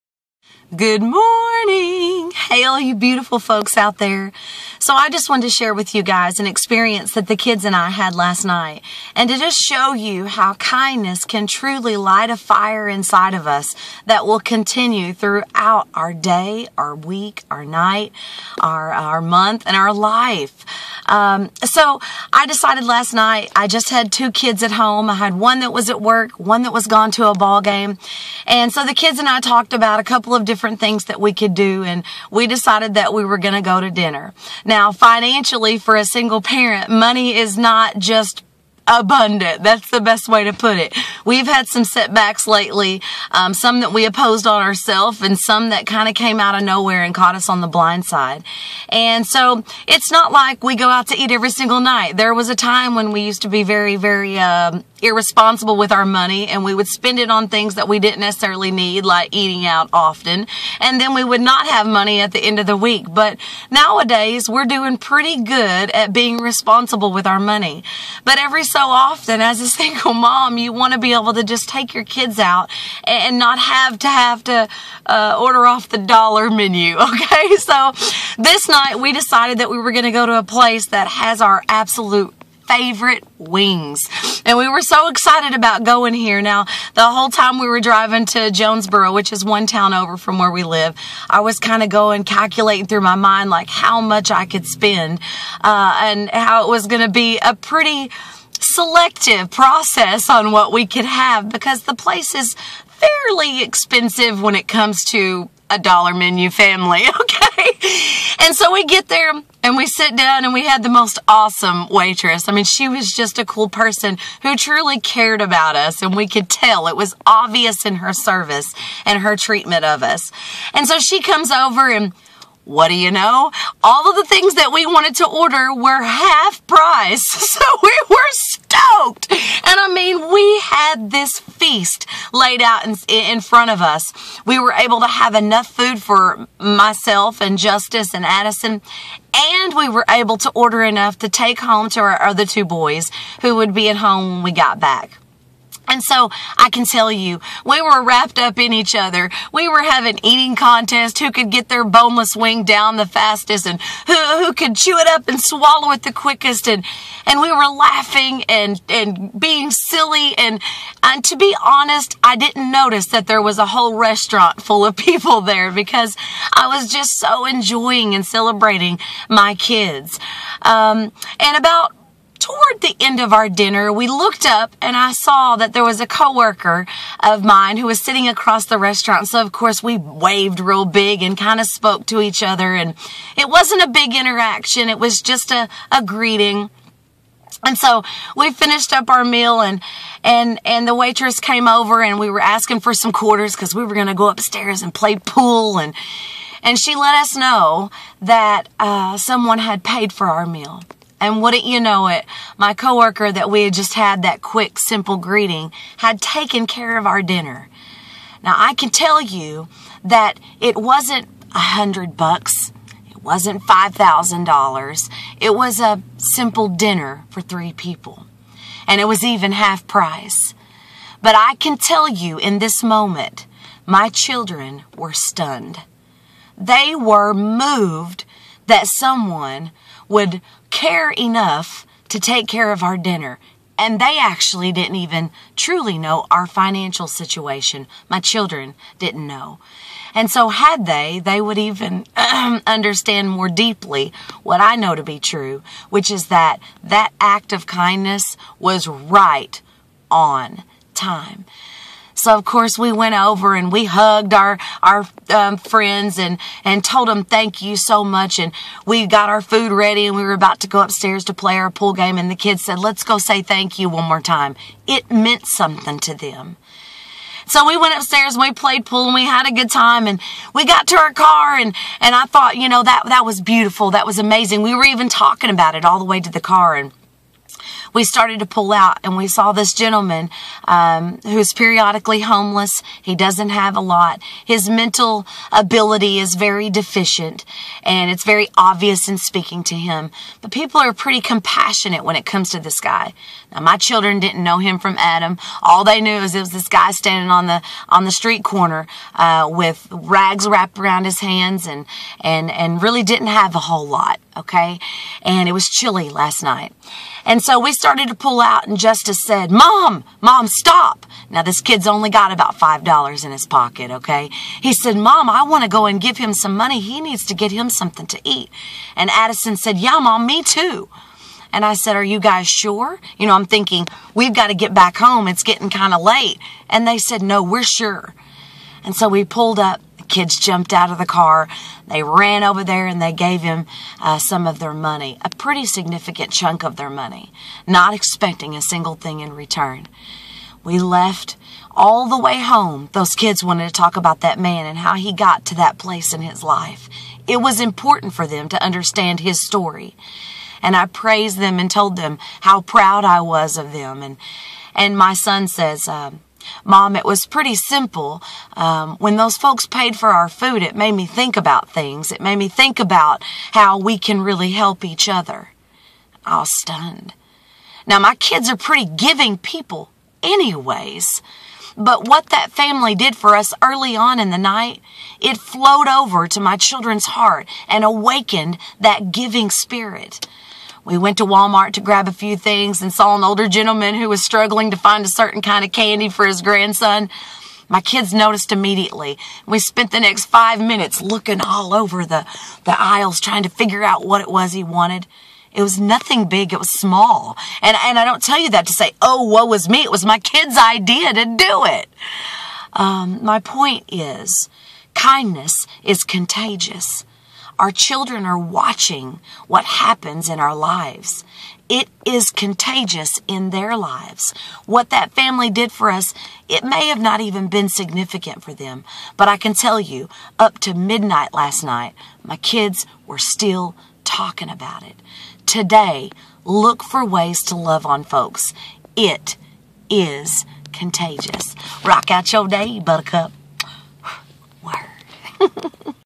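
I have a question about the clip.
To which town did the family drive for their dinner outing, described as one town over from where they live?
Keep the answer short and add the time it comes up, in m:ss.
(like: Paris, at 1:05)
Jonesboro, at 1:28.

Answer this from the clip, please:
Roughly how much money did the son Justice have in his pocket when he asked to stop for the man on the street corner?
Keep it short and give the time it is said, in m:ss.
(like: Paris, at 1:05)
$5, at 5:12.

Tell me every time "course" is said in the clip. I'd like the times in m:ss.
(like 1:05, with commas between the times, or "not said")
2:59, 4:12.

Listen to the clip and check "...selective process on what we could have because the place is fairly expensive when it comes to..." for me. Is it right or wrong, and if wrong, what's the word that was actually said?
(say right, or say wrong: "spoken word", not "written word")
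right.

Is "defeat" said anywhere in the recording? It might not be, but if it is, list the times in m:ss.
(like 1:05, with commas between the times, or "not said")
not said.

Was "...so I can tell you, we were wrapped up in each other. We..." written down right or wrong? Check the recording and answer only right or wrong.
right.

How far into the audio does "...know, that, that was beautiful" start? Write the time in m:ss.
4:32.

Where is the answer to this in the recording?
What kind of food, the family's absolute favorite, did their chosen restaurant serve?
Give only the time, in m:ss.
1:23.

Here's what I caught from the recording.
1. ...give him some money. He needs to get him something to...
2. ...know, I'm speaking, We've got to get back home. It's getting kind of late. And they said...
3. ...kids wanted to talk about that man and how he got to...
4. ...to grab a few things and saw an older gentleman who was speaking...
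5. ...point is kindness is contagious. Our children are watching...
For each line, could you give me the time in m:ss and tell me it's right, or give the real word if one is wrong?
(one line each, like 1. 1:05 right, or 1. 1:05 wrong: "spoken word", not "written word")
1. 5:16 right
2. 5:23 wrong: "thinking", not "speaking"
3. 5:43 right
4. 6:21 wrong: "struggling", not "speaking"
5. 6:43 right.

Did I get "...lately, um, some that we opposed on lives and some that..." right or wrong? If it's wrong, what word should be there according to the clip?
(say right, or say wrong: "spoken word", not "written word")
wrong: "ourselves", not "lives".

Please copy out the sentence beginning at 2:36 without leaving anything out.
And, and we were laughing and, and being silly.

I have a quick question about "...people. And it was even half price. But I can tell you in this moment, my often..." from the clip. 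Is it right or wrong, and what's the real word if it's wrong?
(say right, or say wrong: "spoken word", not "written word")
wrong: "children", not "often".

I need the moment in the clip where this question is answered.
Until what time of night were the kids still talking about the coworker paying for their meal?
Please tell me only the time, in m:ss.
7:00.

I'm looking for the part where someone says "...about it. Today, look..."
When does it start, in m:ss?
7:04.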